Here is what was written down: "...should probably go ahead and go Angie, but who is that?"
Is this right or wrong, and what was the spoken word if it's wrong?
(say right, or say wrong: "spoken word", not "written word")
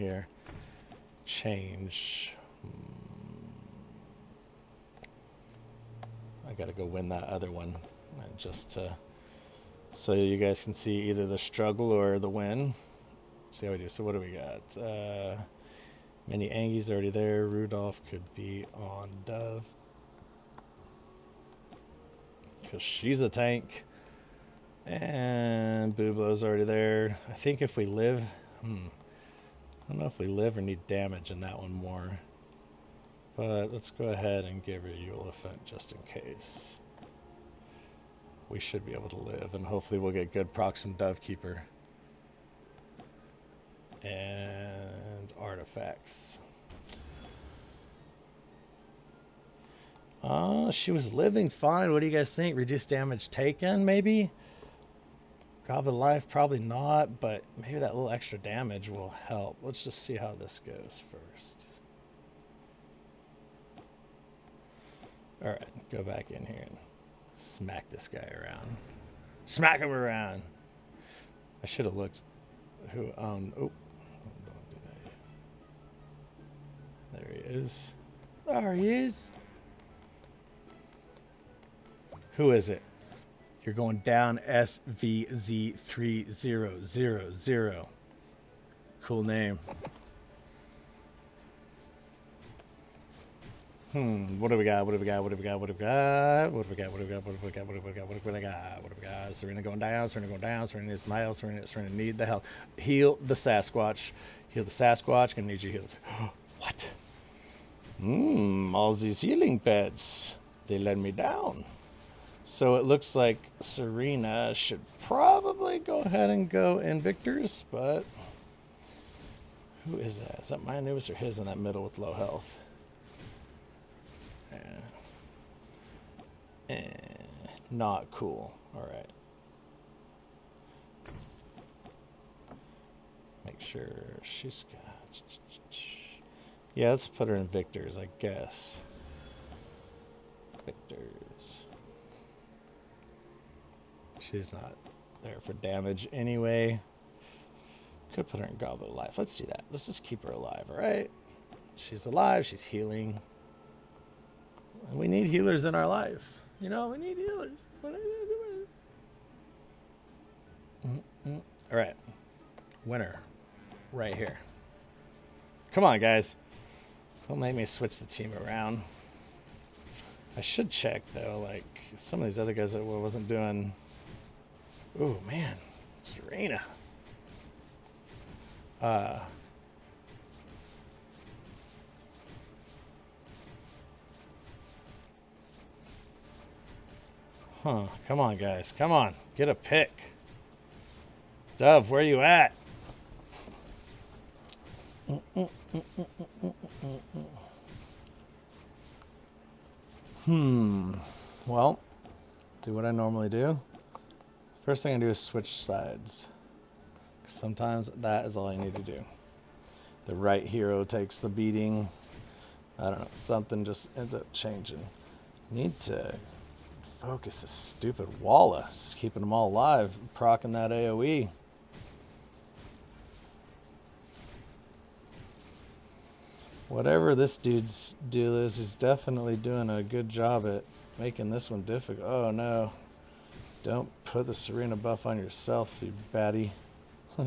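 wrong: "Invictors", not "Angie".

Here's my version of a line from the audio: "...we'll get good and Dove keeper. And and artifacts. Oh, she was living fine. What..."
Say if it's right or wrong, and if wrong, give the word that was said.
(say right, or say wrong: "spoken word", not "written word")
right.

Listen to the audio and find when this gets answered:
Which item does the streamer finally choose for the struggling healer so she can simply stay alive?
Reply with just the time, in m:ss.
2:28.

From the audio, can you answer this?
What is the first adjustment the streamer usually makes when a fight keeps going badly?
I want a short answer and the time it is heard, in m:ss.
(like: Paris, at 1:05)
Switch sides, at 3:25.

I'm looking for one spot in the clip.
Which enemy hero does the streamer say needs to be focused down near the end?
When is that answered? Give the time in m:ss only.
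3:38.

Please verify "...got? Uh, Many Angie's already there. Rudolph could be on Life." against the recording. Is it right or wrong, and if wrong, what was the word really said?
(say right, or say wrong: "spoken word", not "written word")
wrong: "Dove", not "Life".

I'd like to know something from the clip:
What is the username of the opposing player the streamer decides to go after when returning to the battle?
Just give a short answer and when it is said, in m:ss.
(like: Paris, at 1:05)
SVZ3000, at 1:24.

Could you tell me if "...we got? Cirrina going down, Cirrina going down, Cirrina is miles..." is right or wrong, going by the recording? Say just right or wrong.
right.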